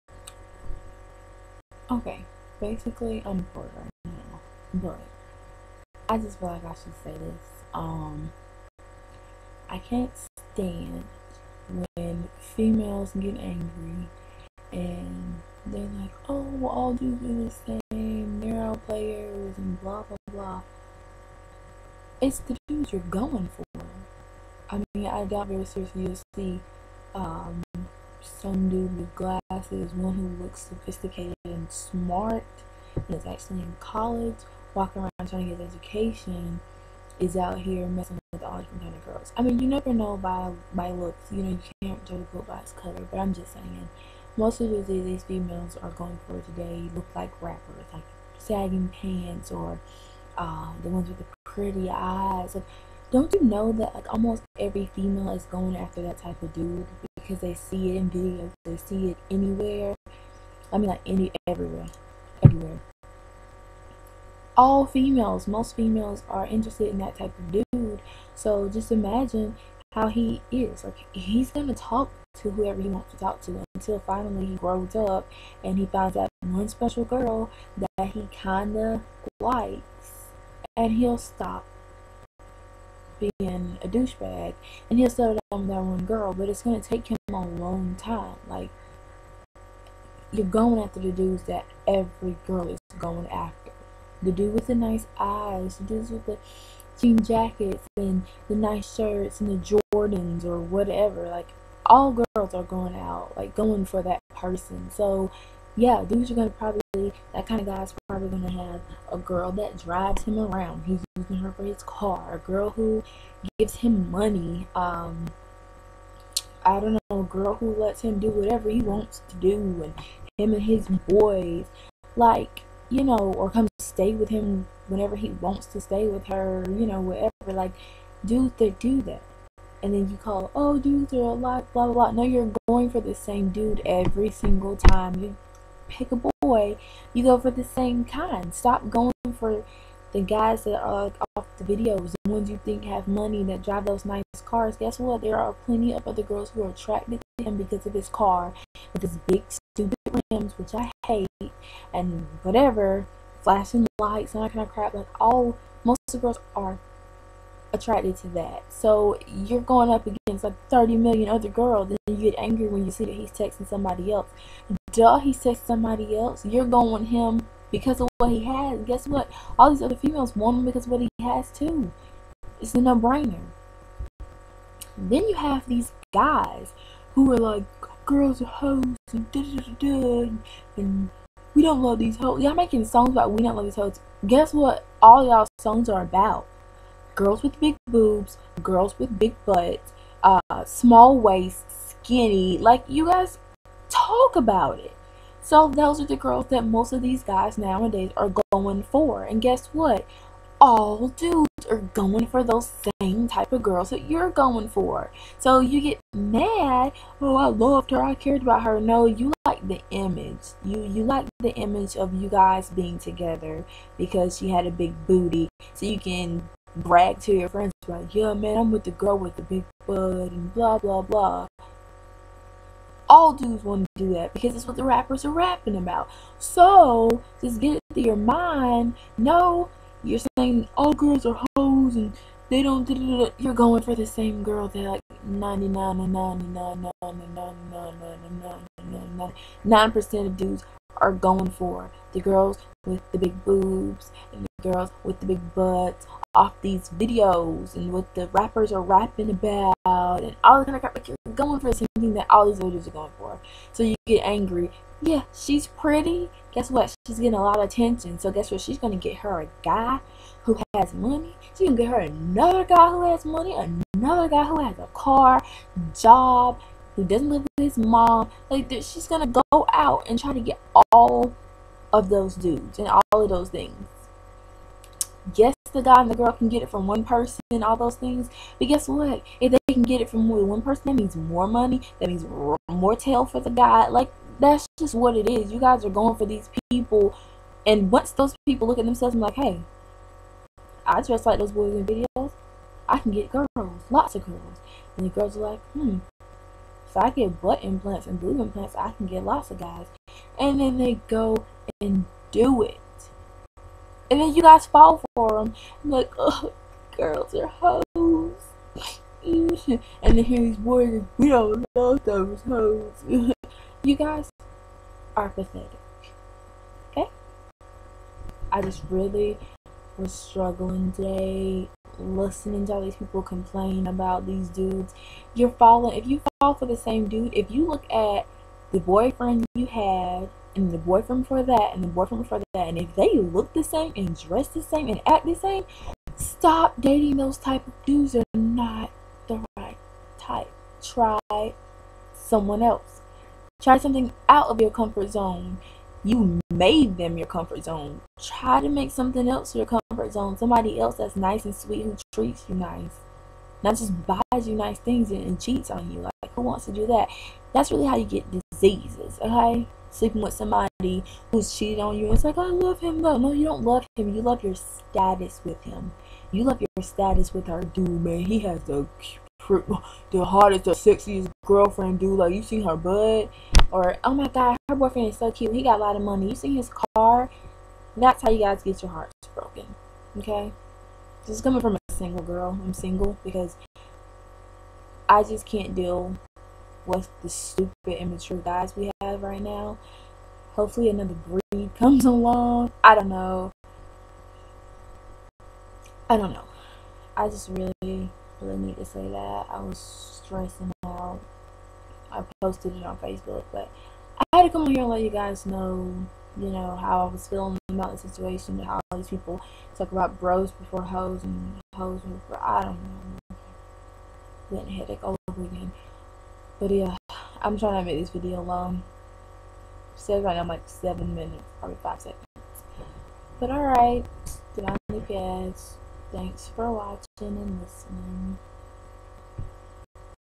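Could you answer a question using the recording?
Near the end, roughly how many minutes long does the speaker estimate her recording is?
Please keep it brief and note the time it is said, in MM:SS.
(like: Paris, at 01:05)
7 minutes, at 07:00.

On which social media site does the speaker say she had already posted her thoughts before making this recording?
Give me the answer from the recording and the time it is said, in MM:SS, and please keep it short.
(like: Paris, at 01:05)
Facebook, at 06:42.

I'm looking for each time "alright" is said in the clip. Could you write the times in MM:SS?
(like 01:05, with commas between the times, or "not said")
07:03.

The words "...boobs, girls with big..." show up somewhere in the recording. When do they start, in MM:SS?
03:07.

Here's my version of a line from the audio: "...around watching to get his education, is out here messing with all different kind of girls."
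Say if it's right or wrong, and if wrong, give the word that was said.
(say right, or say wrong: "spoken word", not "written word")
wrong: "trying", not "watching".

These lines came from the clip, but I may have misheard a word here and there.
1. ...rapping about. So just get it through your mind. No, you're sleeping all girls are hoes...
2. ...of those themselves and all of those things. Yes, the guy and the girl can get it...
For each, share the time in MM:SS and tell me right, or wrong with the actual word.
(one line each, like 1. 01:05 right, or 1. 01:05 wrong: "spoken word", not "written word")
1. 03:45 wrong: "saying", not "sleeping"
2. 04:31 wrong: "dudes", not "themselves".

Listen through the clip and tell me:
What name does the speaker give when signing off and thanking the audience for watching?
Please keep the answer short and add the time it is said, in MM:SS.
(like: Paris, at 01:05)
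Delani Cash, at 07:04.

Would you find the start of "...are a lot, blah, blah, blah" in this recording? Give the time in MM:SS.
02:11.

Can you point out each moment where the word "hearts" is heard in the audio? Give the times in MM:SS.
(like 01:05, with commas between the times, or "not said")
06:18.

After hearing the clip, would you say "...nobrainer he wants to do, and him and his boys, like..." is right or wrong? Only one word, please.
wrong.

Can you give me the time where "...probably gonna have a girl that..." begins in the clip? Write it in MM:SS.
01:48.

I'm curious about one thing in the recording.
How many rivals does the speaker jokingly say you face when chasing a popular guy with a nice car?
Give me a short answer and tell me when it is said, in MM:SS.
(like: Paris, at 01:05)
30 million, at 02:40.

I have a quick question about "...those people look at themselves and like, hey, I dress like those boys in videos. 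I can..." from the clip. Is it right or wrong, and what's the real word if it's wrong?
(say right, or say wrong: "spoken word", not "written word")
right.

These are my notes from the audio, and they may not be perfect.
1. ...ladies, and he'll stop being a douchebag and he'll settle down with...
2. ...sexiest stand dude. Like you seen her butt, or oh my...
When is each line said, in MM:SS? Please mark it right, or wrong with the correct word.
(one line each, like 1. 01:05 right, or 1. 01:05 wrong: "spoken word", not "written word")
1. 01:19 wrong: "likes", not "ladies"
2. 06:10 wrong: "girlfriend", not "stand".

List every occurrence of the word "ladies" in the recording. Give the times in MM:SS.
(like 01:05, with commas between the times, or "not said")
04:12.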